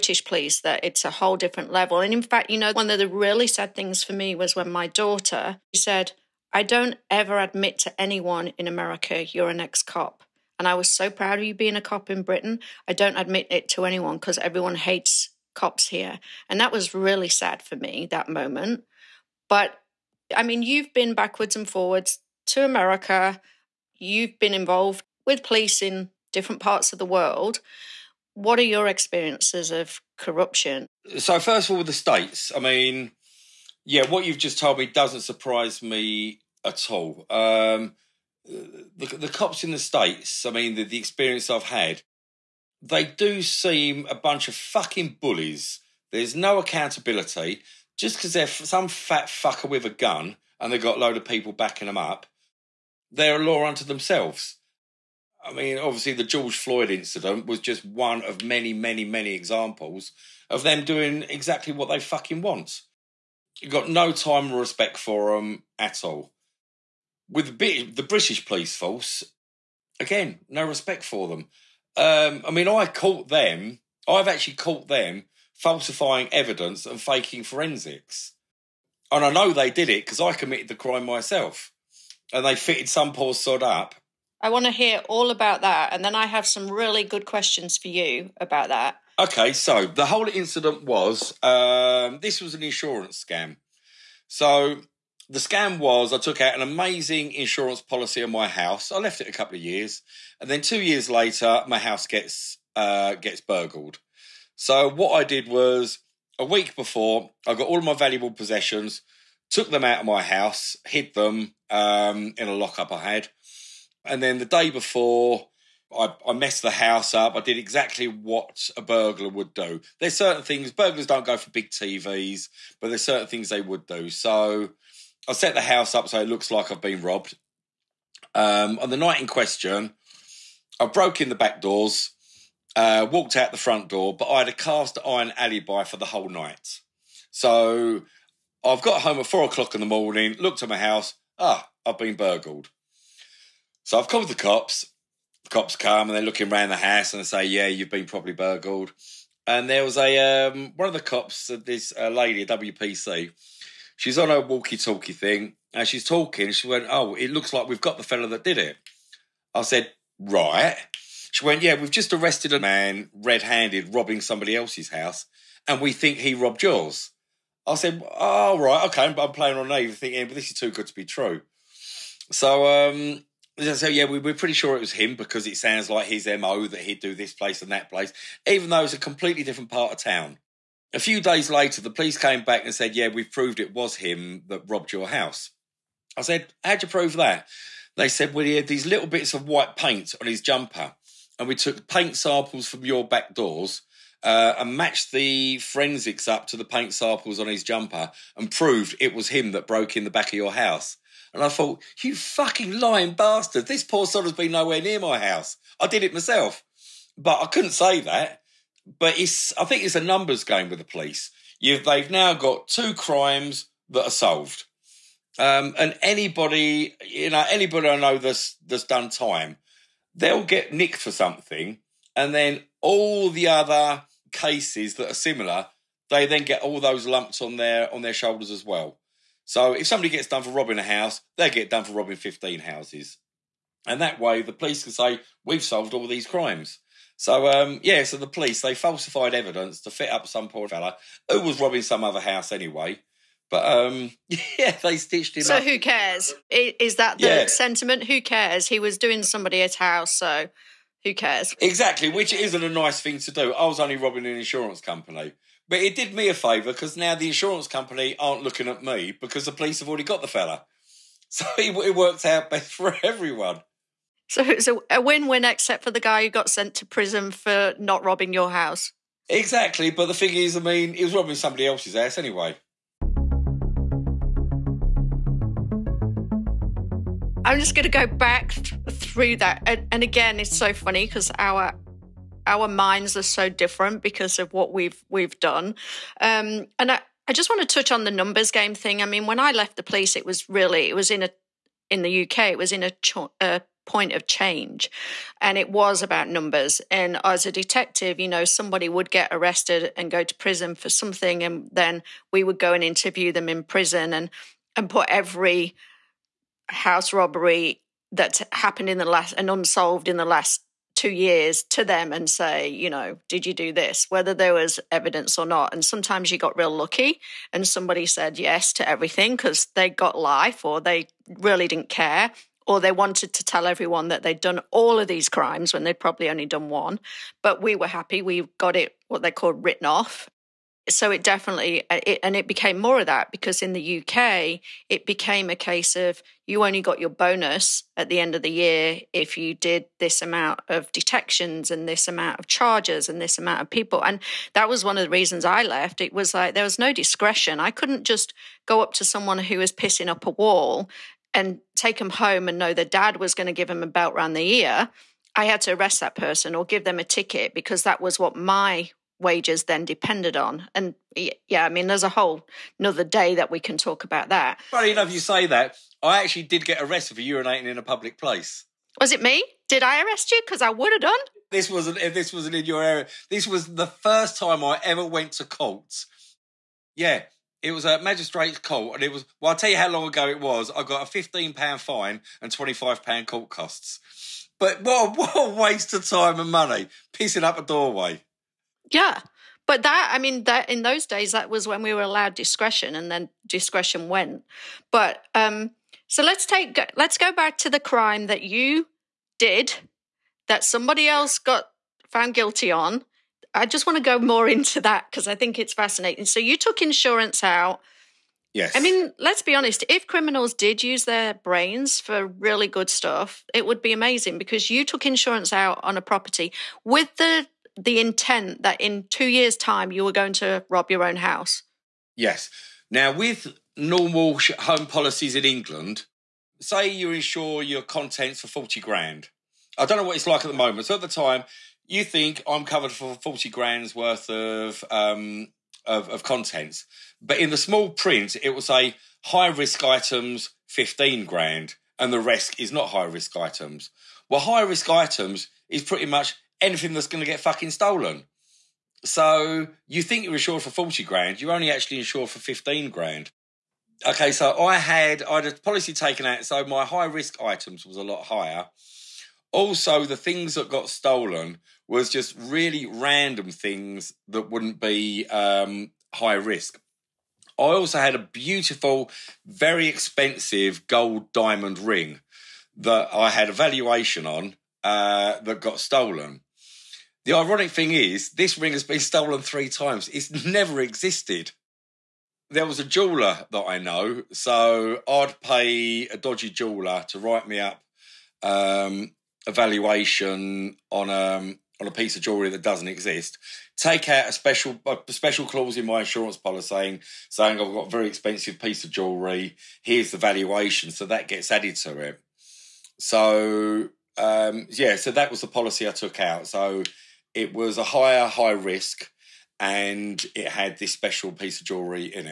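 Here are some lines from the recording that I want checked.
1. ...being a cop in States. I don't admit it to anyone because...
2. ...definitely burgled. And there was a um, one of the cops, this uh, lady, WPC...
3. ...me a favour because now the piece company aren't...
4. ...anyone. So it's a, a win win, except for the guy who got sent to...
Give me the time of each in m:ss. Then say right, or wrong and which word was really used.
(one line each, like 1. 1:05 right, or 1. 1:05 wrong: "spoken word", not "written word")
1. 0:11 wrong: "Britain", not "States"
2. 2:28 wrong: "properly", not "definitely"
3. 4:16 wrong: "insurance", not "piece"
4. 4:23 wrong: "everyone", not "anyone".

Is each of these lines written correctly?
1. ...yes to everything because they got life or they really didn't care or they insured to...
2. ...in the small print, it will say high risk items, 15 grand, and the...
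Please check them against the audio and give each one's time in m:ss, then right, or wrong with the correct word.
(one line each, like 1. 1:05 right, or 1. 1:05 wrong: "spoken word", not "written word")
1. 5:18 wrong: "wanted", not "insured"
2. 7:17 right.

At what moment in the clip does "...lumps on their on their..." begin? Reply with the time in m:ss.
3:47.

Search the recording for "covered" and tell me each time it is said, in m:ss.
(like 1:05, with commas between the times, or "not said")
7:12.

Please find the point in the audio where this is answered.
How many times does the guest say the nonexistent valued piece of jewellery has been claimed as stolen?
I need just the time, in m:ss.
7:59.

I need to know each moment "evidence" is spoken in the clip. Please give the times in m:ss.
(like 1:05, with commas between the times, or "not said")
1:16, 3:59, 5:14.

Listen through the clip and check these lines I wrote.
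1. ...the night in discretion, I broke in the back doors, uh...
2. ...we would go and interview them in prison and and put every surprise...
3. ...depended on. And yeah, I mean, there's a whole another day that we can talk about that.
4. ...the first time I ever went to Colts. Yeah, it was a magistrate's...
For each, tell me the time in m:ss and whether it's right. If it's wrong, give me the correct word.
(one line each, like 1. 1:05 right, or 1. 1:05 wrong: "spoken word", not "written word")
1. 2:08 wrong: "question", not "discretion"
2. 5:02 wrong: "house", not "surprise"
3. 5:59 right
4. 6:13 right.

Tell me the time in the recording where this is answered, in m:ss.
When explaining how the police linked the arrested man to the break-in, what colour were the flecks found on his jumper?
3:09.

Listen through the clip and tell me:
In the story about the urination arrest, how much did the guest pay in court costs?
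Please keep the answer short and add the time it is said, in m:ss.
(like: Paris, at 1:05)
£25, at 6:22.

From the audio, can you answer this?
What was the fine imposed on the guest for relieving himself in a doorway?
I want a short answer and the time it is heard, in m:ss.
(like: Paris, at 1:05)
£15, at 6:21.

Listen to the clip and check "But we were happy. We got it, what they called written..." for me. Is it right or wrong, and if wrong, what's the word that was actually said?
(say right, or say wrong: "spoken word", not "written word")
right.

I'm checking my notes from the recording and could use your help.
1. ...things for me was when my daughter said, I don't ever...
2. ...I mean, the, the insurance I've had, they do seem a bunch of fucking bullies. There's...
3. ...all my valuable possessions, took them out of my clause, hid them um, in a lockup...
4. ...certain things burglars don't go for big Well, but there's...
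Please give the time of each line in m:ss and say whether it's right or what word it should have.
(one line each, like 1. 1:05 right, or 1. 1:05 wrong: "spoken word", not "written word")
1. 0:03 right
2. 0:40 wrong: "experience", not "insurance"
3. 1:47 wrong: "house", not "clause"
4. 2:00 wrong: "TVs", not "Well".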